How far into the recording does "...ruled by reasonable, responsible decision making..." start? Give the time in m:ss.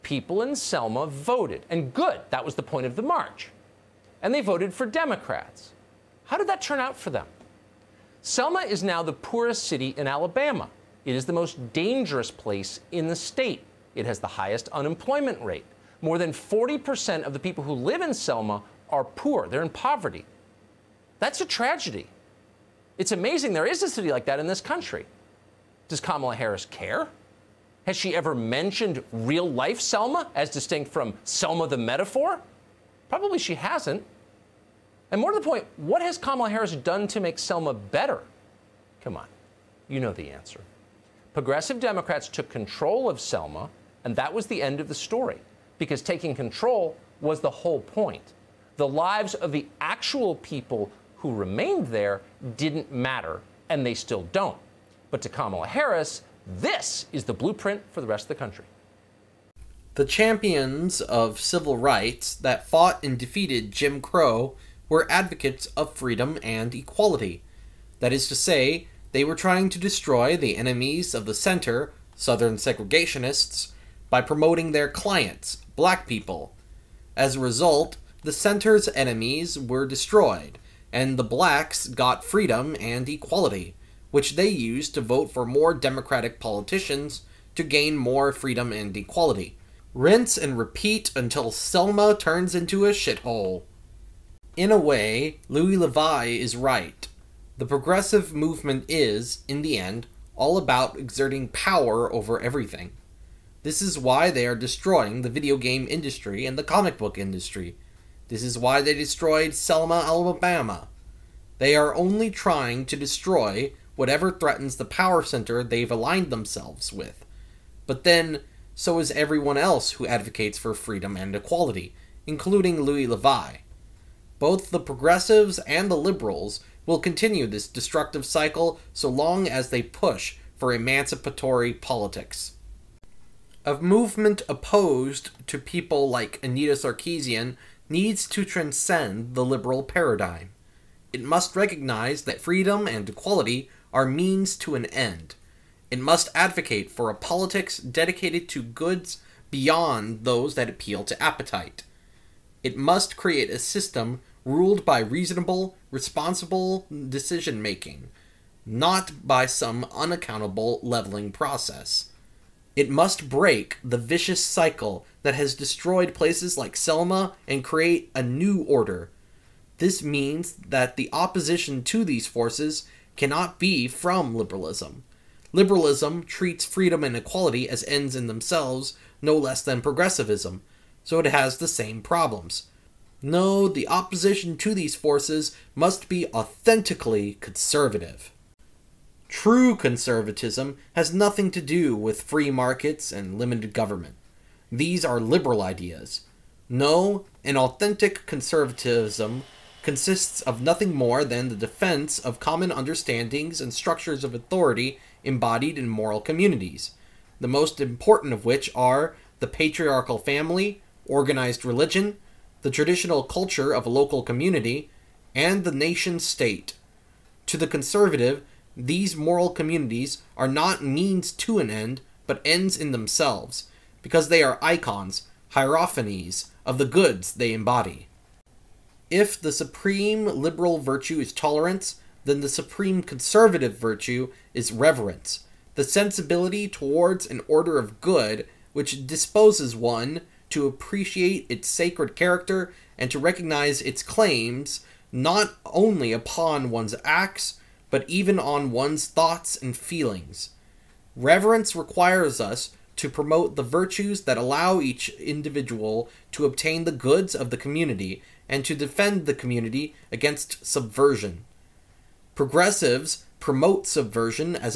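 2:34.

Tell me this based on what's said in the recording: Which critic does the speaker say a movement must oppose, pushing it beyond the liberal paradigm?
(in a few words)
Anita Sarkeesian.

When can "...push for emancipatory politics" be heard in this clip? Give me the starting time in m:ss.
2:09.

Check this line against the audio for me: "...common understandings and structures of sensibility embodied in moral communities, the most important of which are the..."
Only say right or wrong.
wrong.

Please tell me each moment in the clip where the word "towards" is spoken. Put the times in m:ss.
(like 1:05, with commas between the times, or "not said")
3:56.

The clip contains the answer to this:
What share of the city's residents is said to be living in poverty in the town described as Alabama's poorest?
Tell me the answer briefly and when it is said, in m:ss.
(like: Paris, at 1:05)
More than 40%, at 0:16.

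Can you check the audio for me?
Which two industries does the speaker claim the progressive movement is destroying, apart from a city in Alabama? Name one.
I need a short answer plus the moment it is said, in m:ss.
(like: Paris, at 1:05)
video game industry, at 1:45.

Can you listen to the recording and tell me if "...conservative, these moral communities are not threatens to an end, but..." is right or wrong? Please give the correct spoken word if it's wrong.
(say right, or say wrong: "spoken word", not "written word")
wrong: "means", not "threatens".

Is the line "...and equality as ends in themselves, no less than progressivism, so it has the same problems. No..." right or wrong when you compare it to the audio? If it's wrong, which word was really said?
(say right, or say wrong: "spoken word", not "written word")
right.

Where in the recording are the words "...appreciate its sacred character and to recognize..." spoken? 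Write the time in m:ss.
4:00.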